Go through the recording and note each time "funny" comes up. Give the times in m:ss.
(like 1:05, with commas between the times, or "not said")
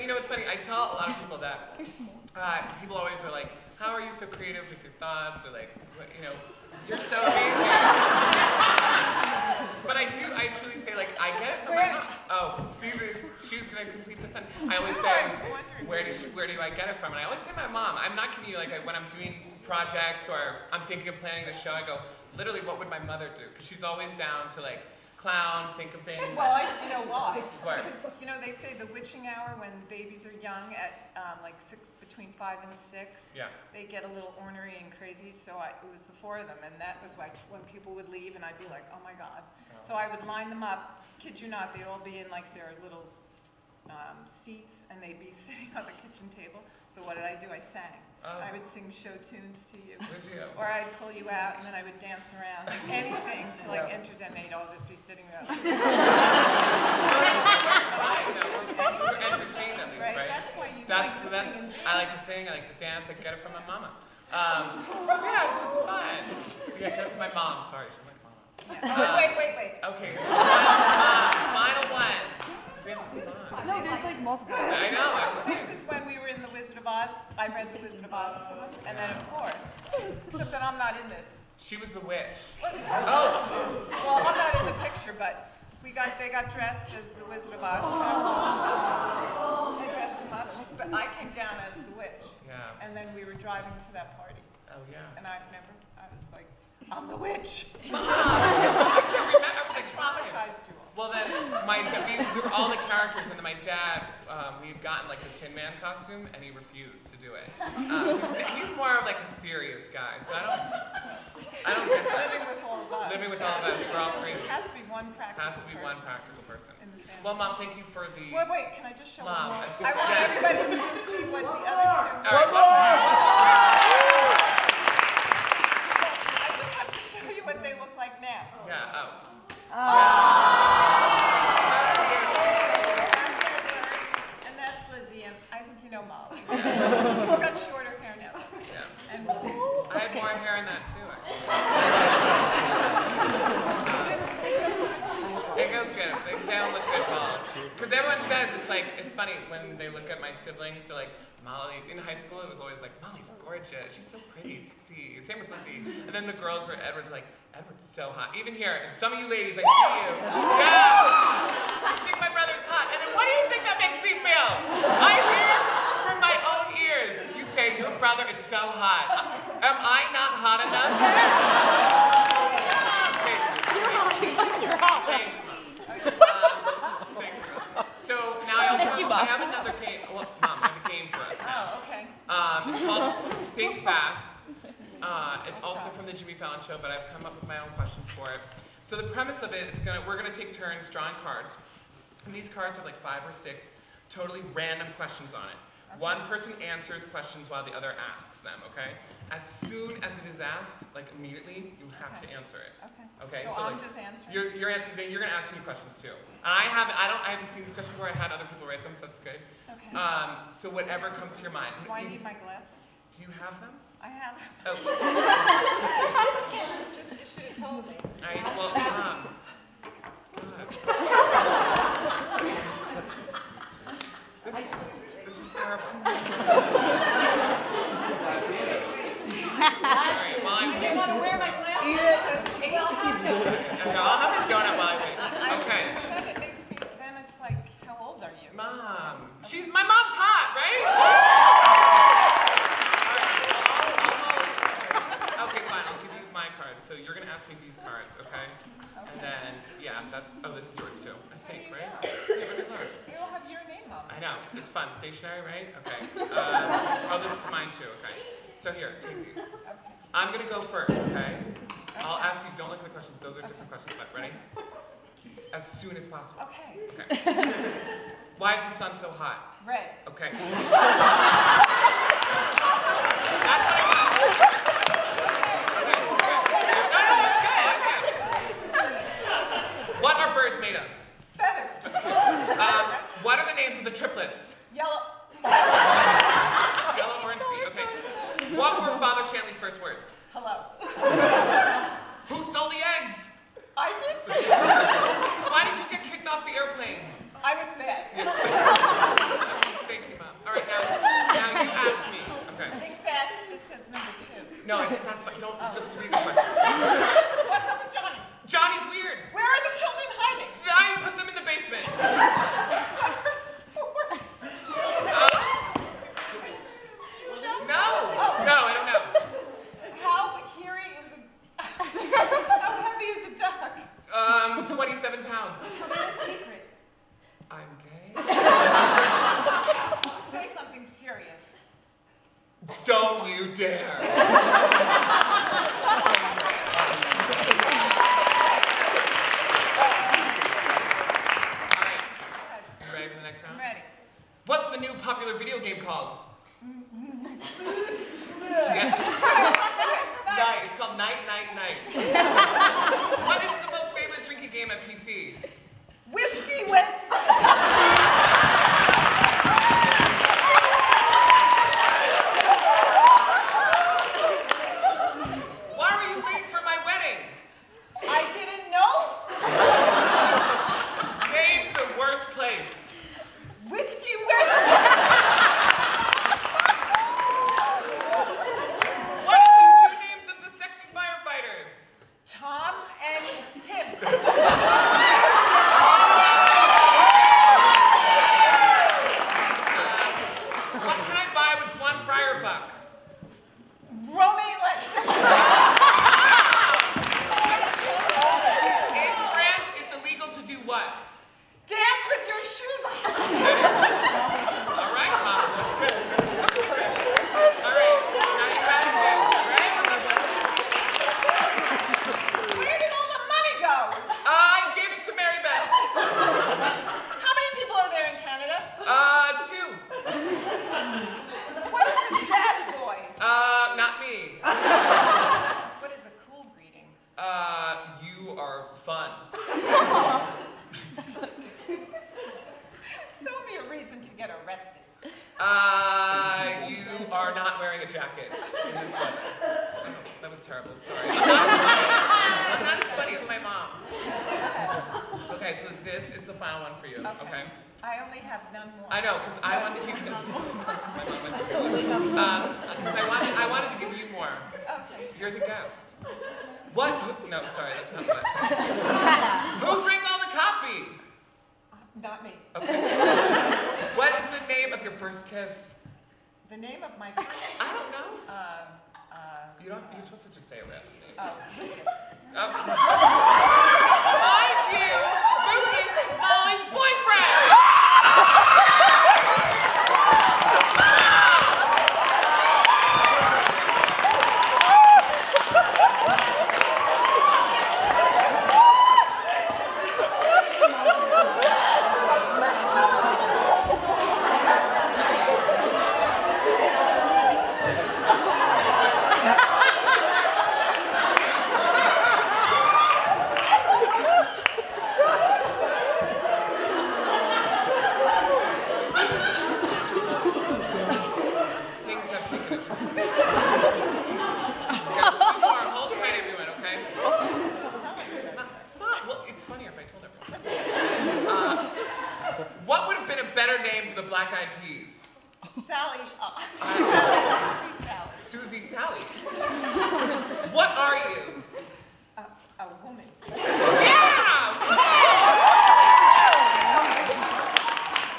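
0:00, 2:29, 7:22.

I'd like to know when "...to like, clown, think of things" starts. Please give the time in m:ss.
0:24.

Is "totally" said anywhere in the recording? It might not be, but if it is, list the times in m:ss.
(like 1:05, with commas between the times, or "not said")
3:14.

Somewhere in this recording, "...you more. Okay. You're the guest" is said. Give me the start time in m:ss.
7:33.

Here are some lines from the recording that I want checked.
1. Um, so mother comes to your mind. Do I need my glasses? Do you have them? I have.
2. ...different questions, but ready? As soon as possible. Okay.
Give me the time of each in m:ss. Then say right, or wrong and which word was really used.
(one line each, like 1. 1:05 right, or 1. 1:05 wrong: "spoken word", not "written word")
1. 3:29 wrong: "whatever", not "mother"
2. 4:23 right.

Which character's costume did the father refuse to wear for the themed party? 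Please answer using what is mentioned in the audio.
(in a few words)
Tin Man.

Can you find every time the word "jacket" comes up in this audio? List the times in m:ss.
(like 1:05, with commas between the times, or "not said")
7:17.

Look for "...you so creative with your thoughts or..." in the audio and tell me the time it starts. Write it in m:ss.
0:04.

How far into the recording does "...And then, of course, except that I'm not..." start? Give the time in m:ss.
1:18.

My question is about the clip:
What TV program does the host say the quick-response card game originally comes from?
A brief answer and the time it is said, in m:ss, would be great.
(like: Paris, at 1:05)
The Jimmy Fallon Show, at 3:06.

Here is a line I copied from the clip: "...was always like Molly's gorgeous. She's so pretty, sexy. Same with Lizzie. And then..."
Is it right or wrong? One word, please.
right.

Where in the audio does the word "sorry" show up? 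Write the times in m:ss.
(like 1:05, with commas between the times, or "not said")
1:07, 7:20, 7:37.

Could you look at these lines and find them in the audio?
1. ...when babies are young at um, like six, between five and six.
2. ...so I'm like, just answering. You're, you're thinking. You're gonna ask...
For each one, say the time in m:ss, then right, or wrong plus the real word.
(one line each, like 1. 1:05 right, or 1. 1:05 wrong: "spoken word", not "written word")
1. 0:29 right
2. 3:23 wrong: "answering", not "thinking".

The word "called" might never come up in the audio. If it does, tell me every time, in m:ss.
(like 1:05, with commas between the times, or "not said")
3:02, 5:45, 5:50.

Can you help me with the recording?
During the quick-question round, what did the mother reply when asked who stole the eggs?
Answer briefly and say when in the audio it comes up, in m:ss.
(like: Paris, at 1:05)
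I did, at 4:53.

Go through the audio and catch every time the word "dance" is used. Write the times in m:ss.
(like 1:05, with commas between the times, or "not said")
0:52, 1:02.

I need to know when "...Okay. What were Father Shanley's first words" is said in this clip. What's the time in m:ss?
4:47.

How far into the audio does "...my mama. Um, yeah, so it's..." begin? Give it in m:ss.
1:03.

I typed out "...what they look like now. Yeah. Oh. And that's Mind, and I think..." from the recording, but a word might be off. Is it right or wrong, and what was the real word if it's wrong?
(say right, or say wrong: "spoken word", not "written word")
wrong: "Lizzie", not "Mind".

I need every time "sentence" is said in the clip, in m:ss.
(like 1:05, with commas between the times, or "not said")
0:14.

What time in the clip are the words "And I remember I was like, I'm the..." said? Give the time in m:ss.
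1:35.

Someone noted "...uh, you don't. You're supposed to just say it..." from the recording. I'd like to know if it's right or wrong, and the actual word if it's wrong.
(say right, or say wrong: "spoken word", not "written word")
right.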